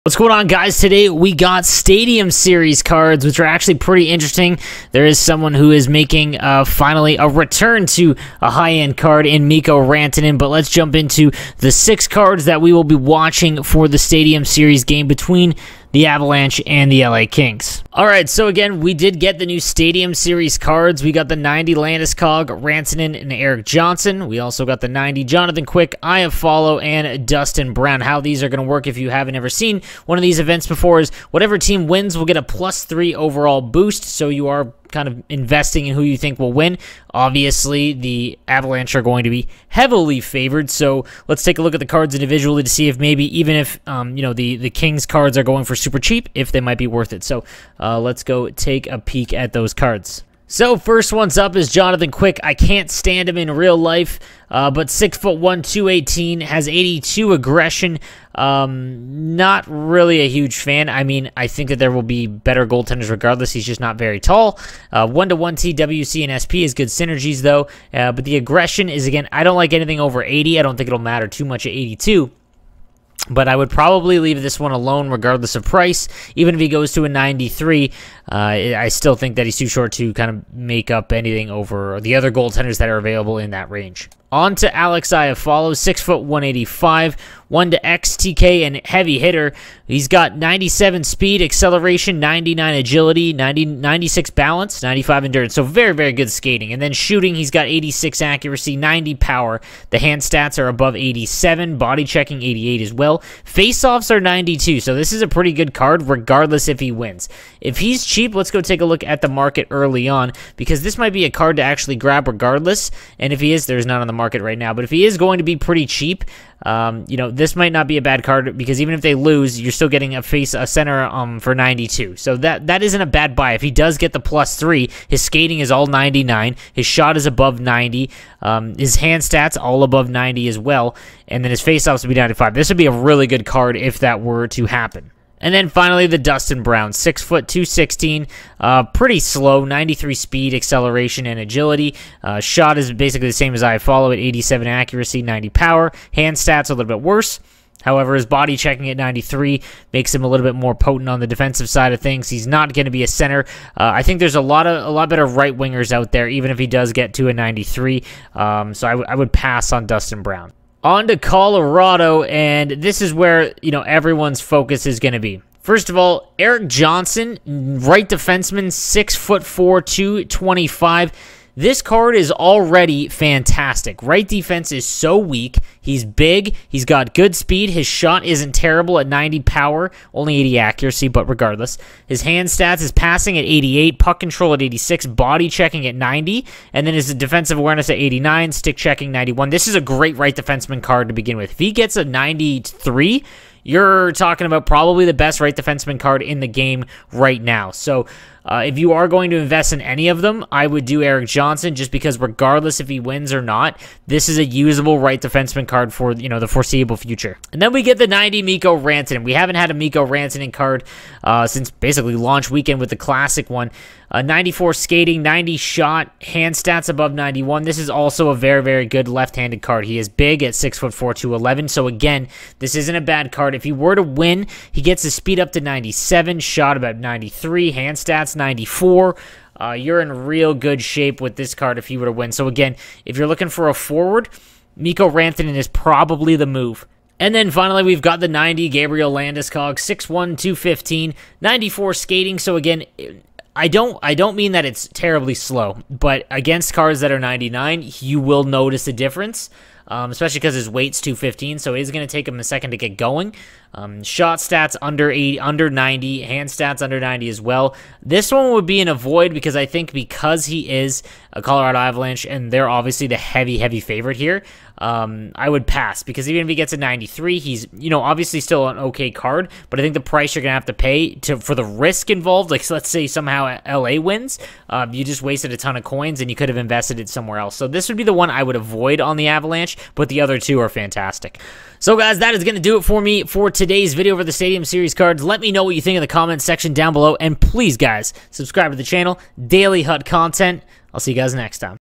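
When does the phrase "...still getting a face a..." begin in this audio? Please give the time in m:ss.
1:59.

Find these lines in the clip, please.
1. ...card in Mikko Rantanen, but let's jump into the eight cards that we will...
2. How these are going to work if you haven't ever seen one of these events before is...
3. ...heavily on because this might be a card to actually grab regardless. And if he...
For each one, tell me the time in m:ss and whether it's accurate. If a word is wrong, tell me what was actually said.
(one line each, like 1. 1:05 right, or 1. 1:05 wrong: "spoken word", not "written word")
1. 0:08 wrong: "six", not "eight"
2. 0:28 right
3. 1:49 wrong: "early", not "heavily".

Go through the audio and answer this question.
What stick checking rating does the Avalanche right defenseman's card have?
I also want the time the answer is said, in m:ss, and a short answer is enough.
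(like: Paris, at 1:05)
91, at 3:08.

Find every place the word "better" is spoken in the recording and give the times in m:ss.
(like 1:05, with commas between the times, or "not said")
1:02, 2:35.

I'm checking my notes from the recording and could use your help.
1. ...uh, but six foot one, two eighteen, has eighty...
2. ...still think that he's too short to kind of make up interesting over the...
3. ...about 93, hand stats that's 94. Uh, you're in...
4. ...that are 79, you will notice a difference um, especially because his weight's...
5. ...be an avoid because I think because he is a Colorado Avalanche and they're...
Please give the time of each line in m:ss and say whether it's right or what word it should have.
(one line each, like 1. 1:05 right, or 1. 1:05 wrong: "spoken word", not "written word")
1. 0:54 right
2. 1:18 wrong: "anything", not "interesting"
3. 3:46 right
4. 4:07 wrong: "99", not "79"
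5. 4:18 right.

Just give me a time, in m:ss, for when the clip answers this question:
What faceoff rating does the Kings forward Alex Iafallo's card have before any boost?
1:43.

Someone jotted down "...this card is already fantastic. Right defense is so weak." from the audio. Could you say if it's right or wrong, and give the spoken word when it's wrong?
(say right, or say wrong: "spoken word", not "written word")
right.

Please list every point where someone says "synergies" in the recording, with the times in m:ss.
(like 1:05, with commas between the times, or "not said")
1:06.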